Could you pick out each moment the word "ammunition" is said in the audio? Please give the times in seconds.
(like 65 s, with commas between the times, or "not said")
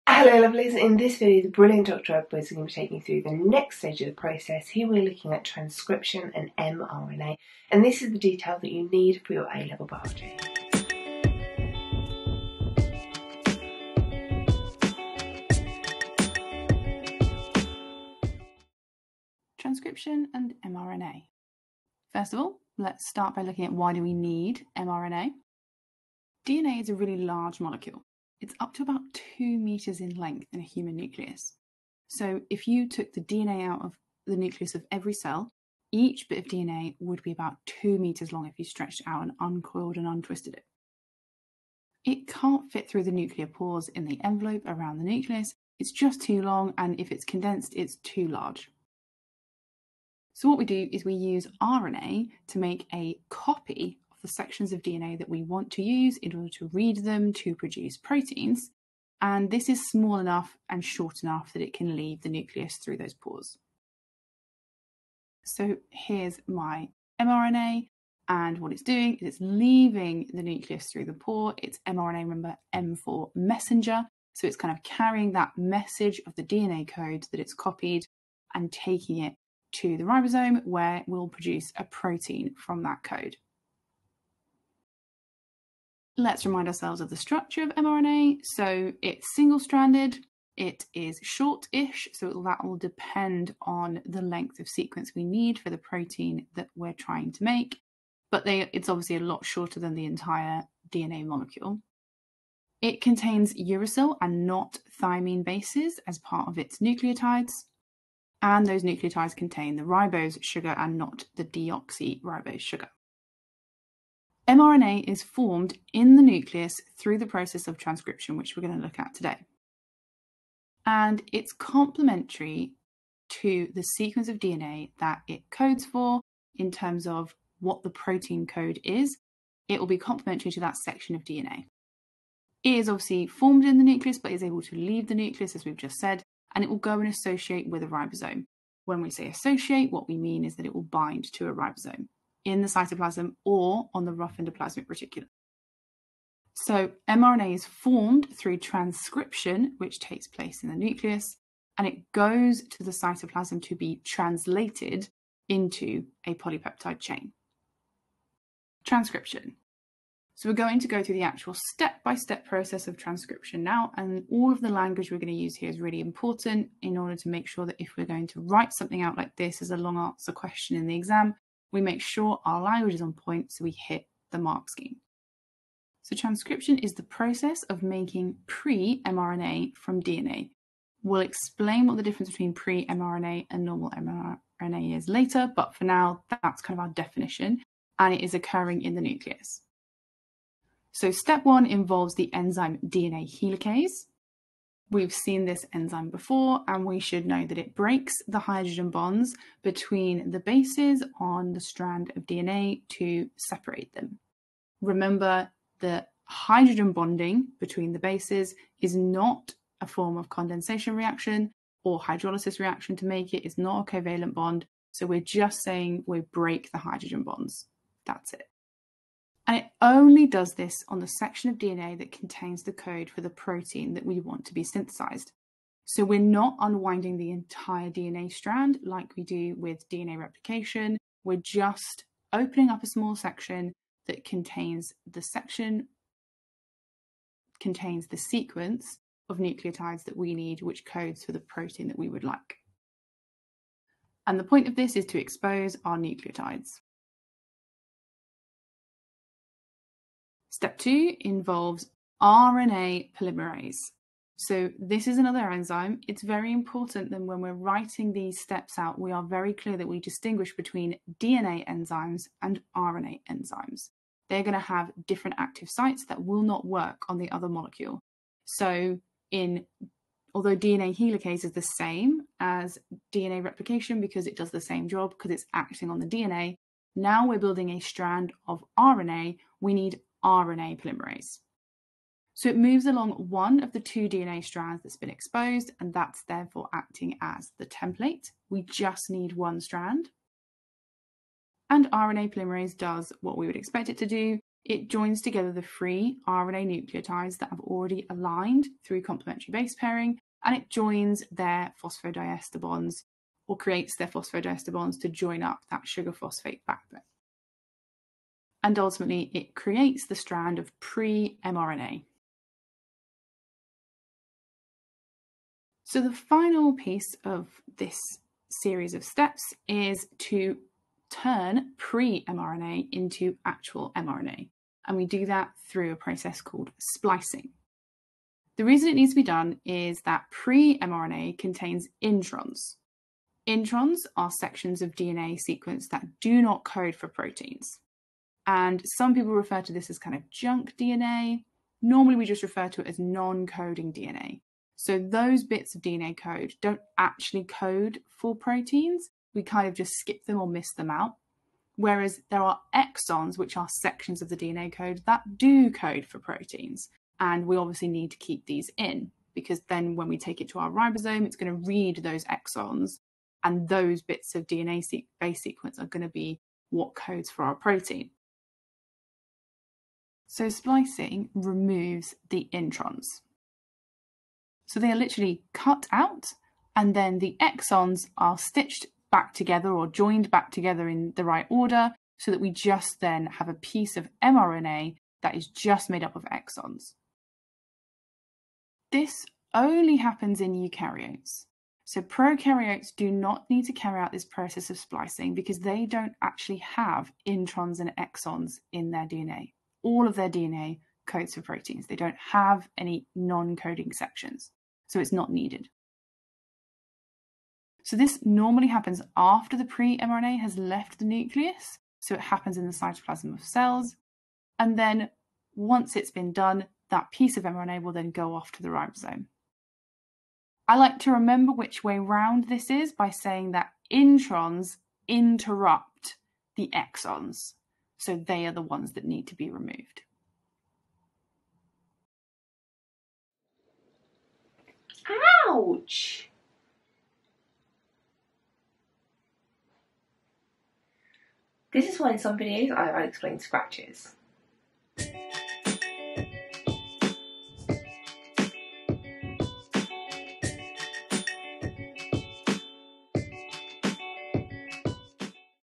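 not said.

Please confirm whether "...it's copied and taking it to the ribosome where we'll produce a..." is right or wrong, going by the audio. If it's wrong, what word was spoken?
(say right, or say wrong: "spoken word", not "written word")
right.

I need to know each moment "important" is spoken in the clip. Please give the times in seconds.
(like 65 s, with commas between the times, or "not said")
165 s, 256 s.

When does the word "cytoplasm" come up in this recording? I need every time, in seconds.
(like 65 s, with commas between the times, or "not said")
142 s, 152 s, 412 s.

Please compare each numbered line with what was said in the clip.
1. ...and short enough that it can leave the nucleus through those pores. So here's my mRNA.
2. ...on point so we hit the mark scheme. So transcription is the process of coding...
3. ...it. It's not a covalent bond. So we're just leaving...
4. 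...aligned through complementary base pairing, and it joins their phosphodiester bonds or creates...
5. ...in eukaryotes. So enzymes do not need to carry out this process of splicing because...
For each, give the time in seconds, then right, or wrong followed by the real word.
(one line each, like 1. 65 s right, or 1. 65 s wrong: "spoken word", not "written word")
1. 60 s right
2. 173 s wrong: "making", not "coding"
3. 213 s wrong: "saying", not "leaving"
4. 298 s right
5. 390 s wrong: "prokaryotes", not "enzymes".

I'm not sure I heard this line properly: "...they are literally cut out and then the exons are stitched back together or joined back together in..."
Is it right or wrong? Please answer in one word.
right.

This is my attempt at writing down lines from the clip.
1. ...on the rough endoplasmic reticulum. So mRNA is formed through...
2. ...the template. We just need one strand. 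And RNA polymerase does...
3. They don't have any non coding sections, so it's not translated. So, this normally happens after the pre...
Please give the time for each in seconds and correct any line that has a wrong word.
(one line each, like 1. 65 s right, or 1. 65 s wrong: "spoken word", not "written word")
1. 143 s right
2. 287 s right
3. 401 s wrong: "needed", not "translated".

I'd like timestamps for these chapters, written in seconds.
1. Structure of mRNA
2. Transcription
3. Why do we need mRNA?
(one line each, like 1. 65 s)
1. 85 s
2. 158 s
3. 18 s.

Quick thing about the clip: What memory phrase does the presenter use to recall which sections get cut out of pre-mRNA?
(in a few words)
Introns interrupt the exons.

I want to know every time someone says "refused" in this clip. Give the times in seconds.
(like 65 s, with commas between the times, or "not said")
not said.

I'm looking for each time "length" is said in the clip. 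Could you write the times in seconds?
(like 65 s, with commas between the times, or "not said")
30 s, 94 s.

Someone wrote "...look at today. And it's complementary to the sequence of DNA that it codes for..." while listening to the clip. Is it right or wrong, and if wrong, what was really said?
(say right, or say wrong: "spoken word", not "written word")
right.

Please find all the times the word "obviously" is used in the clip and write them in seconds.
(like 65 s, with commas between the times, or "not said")
98 s, 132 s, 357 s.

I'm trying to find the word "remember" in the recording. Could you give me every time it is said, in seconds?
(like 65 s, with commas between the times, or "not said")
72 s, 204 s, 421 s.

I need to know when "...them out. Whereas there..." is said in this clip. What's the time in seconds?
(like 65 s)
350 s.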